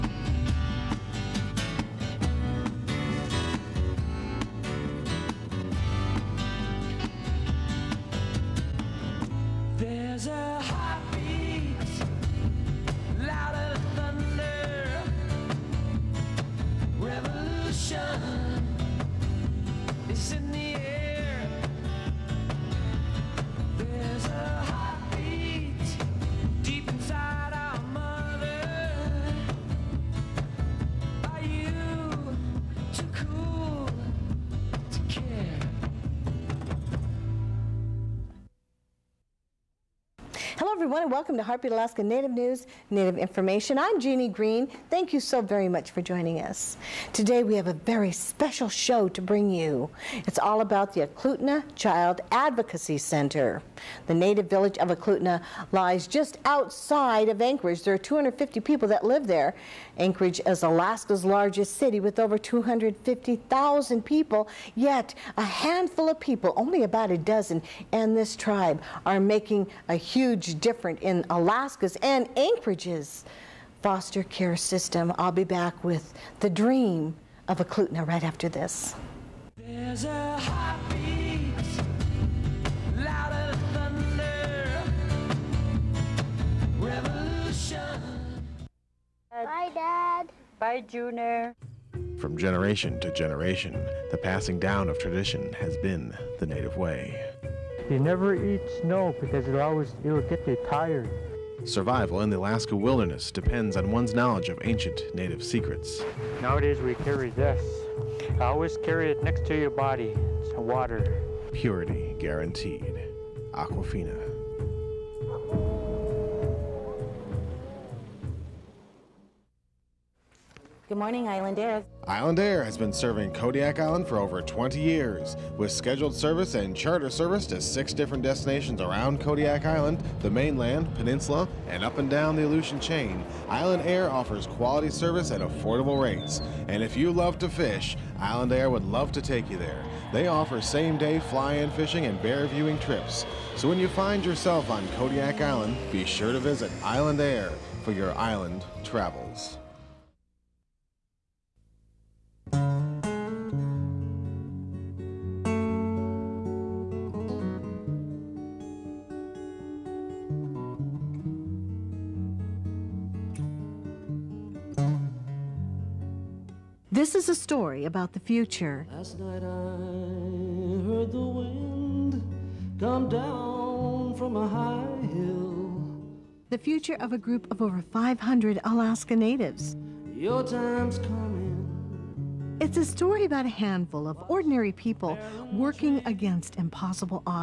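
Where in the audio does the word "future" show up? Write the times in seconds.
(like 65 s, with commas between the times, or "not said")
168 s, 176 s.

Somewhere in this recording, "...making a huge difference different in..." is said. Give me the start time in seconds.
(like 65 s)
69 s.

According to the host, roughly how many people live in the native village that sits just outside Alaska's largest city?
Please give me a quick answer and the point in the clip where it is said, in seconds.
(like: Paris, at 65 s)
250, at 57 s.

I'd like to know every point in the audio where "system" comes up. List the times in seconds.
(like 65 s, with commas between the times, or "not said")
74 s.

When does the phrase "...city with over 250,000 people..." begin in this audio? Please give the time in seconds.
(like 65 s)
61 s.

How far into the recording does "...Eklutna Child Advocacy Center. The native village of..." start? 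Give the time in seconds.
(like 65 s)
51 s.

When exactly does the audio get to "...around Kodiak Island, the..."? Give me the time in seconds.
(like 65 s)
128 s.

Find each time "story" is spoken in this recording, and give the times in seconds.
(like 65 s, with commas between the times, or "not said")
167 s, 182 s.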